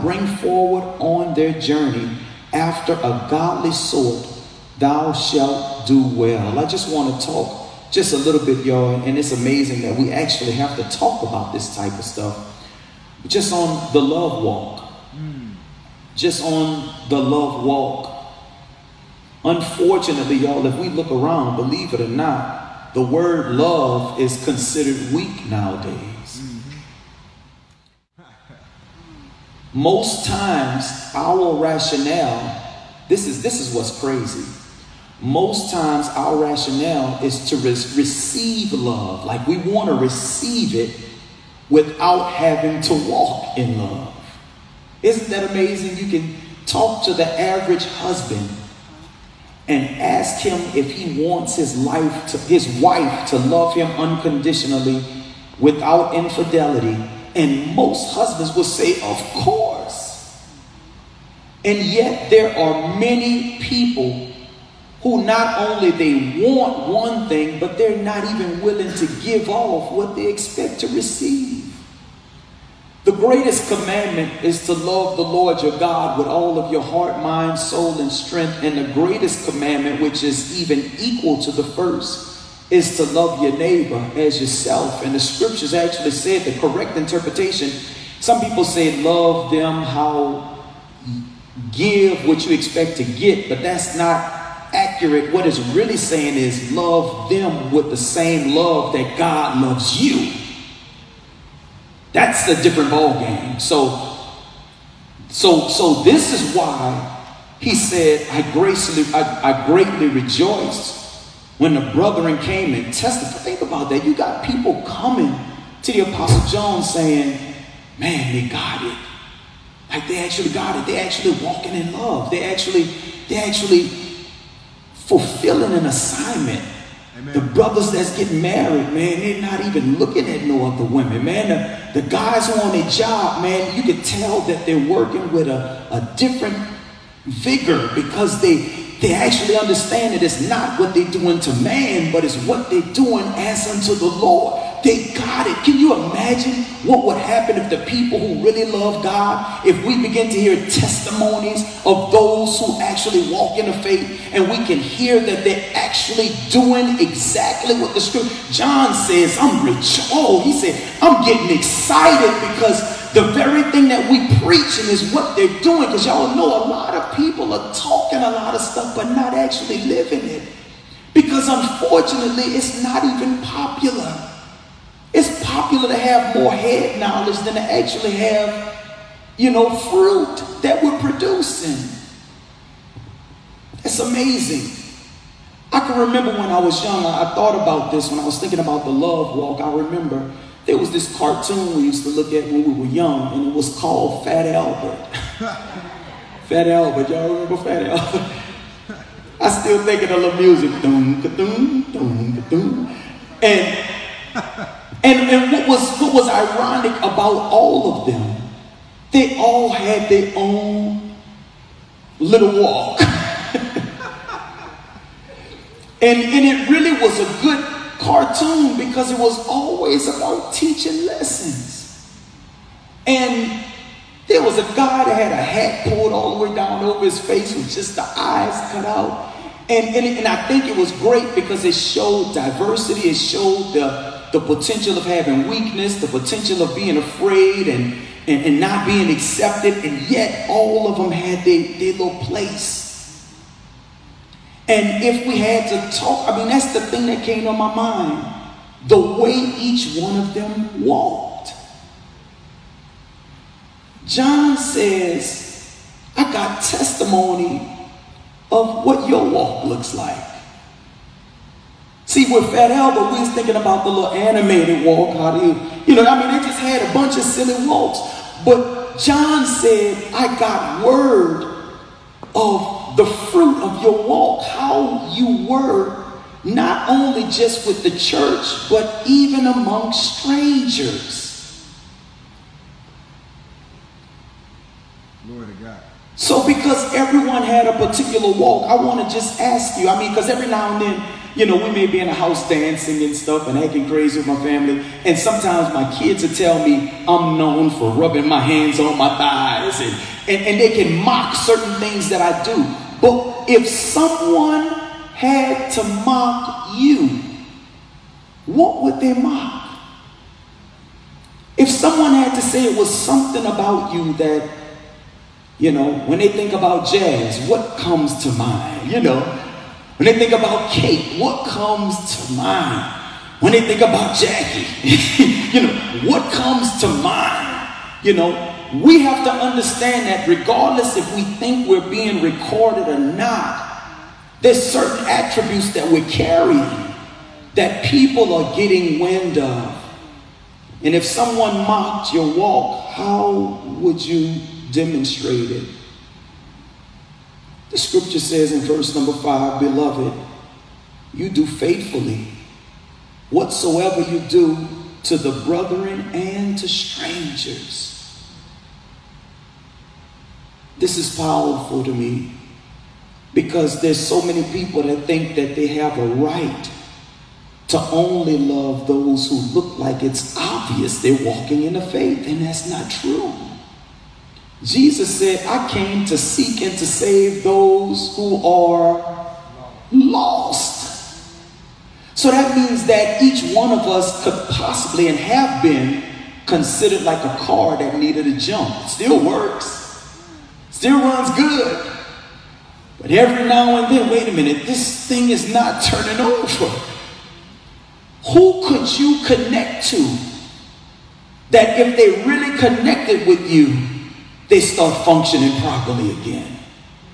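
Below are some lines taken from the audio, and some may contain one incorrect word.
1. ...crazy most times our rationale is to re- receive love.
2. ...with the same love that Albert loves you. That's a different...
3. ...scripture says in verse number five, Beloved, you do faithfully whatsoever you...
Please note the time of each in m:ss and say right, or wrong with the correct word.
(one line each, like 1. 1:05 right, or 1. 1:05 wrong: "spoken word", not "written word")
1. 0:34 right
2. 1:37 wrong: "God", not "Albert"
3. 5:47 right.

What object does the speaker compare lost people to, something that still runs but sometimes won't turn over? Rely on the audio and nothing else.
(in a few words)
A car that needed a jump.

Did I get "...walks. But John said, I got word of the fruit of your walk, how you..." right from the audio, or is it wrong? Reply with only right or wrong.
right.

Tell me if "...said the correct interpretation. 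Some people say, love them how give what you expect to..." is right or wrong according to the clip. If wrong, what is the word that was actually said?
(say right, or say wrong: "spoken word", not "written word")
right.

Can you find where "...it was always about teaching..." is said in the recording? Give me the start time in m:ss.
3:39.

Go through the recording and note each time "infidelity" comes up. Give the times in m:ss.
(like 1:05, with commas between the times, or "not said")
0:56.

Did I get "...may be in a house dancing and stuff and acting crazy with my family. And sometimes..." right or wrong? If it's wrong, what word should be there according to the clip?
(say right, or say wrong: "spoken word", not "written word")
right.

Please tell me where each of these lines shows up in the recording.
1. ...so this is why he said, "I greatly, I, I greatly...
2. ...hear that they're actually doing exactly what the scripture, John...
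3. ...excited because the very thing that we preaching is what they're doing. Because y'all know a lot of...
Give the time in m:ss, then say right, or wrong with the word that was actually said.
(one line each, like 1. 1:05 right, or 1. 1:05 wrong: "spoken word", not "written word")
1. 1:45 wrong: "graciously", not "greatly"
2. 2:34 right
3. 2:41 right.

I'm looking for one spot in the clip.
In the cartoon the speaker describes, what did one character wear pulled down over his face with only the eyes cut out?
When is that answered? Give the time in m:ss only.
3:45.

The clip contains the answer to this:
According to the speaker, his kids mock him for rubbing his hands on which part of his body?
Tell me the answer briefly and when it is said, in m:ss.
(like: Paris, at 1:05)
Thighs, at 4:59.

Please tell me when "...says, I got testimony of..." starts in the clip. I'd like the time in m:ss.
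4:14.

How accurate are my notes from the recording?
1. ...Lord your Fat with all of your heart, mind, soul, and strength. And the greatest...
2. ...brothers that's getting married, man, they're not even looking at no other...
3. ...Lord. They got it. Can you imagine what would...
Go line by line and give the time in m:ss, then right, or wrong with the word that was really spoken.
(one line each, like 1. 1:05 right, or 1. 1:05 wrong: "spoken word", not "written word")
1. 1:15 wrong: "God", not "Fat"
2. 2:07 right
3. 2:24 right.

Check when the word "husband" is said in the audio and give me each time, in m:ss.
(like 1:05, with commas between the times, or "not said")
0:47, 0:58.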